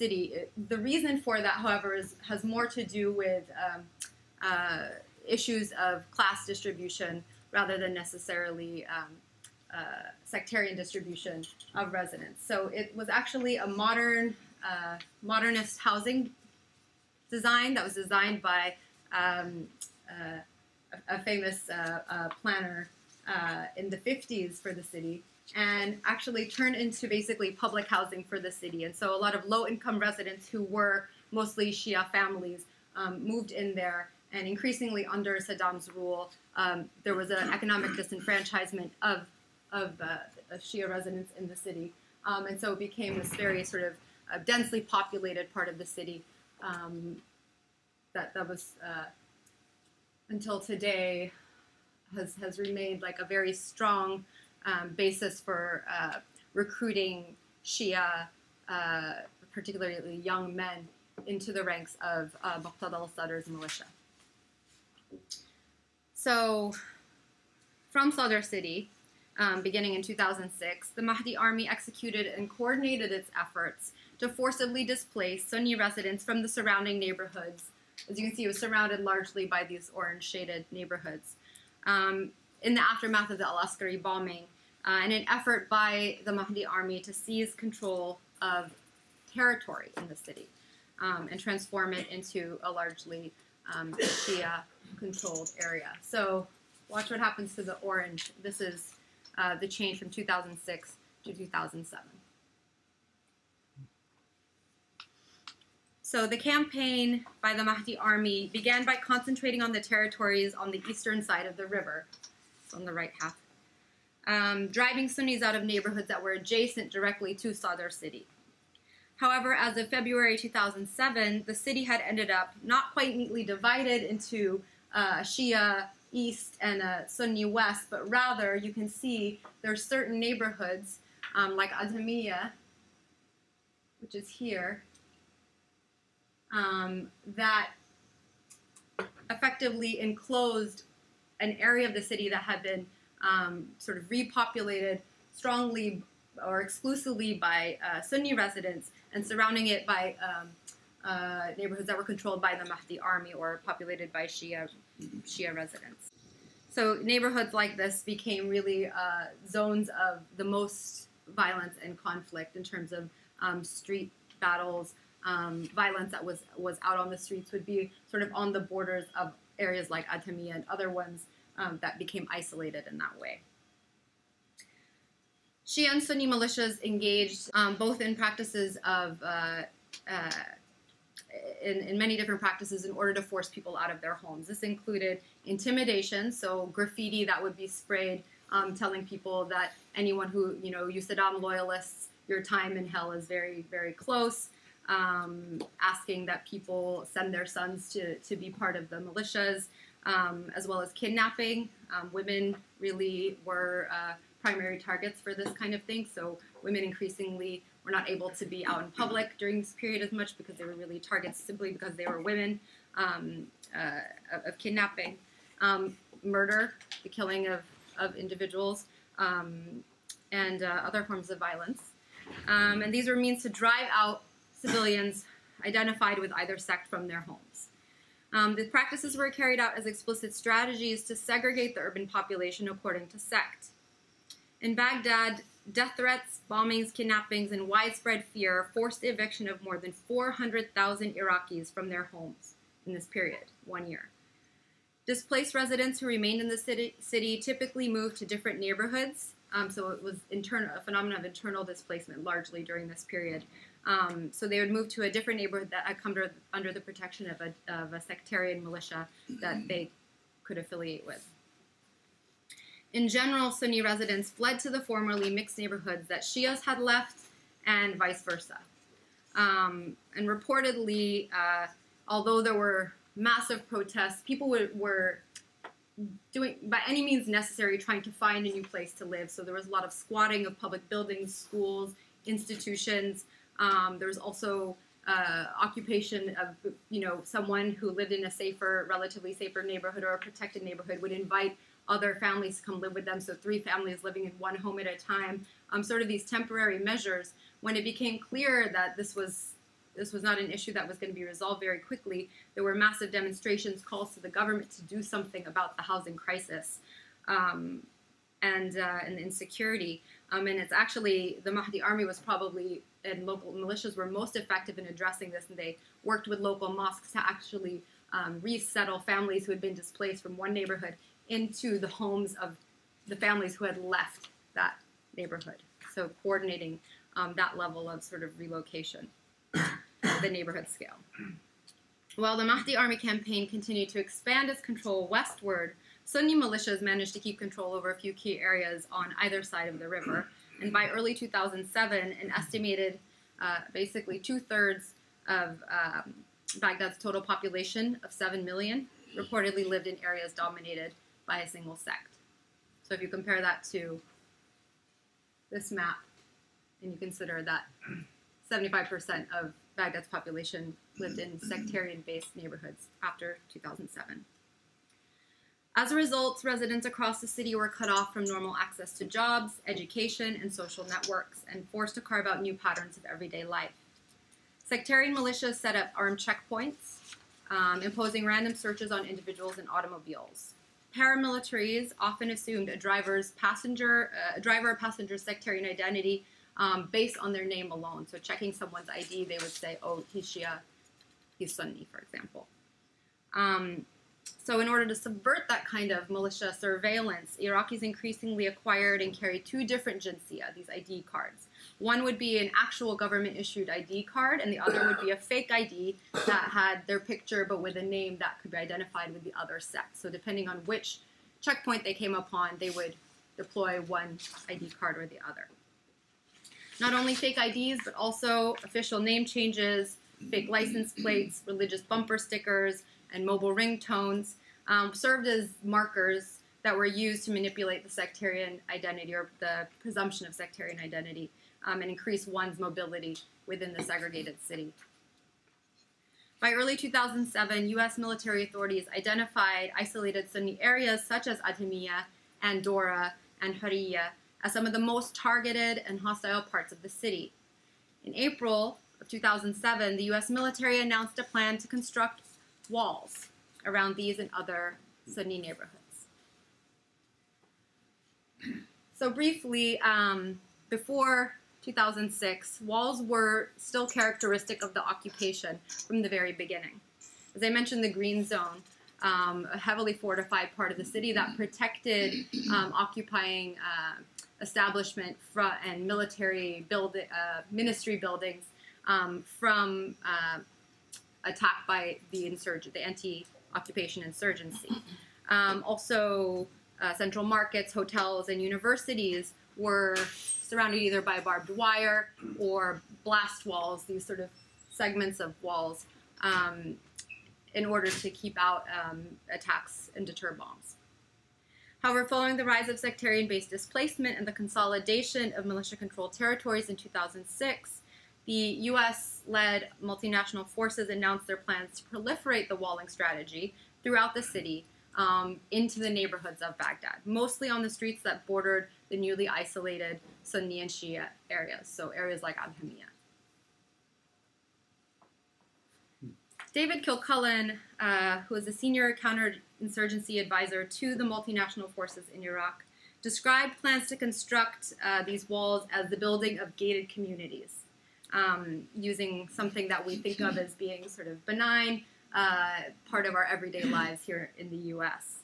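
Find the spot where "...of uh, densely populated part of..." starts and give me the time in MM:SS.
00:43.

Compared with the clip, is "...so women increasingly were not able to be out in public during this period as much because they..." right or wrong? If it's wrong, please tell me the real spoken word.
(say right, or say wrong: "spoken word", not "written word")
right.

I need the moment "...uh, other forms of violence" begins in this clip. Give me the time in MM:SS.
03:40.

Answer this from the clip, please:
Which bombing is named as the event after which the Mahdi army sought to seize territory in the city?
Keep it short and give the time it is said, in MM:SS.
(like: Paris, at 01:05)
Al Askari bombing, at 01:23.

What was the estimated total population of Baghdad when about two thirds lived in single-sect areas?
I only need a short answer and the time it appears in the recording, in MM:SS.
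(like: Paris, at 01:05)
7 million, at 05:48.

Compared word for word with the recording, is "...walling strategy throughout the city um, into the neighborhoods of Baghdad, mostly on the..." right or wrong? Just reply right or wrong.
right.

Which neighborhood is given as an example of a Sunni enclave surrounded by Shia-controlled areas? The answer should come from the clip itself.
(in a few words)
Adamiya.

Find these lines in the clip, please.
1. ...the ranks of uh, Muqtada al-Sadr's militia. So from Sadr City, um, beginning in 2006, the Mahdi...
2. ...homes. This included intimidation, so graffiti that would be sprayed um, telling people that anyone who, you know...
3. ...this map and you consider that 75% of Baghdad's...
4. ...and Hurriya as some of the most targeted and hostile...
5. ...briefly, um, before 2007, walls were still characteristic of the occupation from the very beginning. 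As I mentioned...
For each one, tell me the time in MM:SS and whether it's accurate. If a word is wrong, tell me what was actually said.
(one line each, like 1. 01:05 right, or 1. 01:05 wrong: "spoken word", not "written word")
1. 01:01 right
2. 03:04 right
3. 05:55 right
4. 07:23 right
5. 07:39 wrong: "2006", not "2007".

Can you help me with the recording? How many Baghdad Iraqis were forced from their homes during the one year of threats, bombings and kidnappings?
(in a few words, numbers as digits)
400,000.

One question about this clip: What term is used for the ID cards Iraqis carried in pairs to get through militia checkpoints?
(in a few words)
jinsia.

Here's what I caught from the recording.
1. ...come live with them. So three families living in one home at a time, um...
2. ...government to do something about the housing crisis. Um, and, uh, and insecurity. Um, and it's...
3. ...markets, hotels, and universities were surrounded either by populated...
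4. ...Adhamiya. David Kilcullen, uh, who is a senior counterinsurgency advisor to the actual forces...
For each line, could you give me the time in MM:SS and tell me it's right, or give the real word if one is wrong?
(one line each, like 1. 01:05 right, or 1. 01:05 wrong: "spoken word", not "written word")
1. 04:52 right
2. 05:04 right
3. 08:07 wrong: "barbed", not "populated"
4. 08:42 wrong: "multinational", not "actual".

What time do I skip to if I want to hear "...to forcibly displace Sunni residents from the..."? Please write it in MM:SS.
01:14.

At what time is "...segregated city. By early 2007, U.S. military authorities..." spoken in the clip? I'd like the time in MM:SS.
07:13.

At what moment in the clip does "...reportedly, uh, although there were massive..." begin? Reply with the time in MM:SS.
04:30.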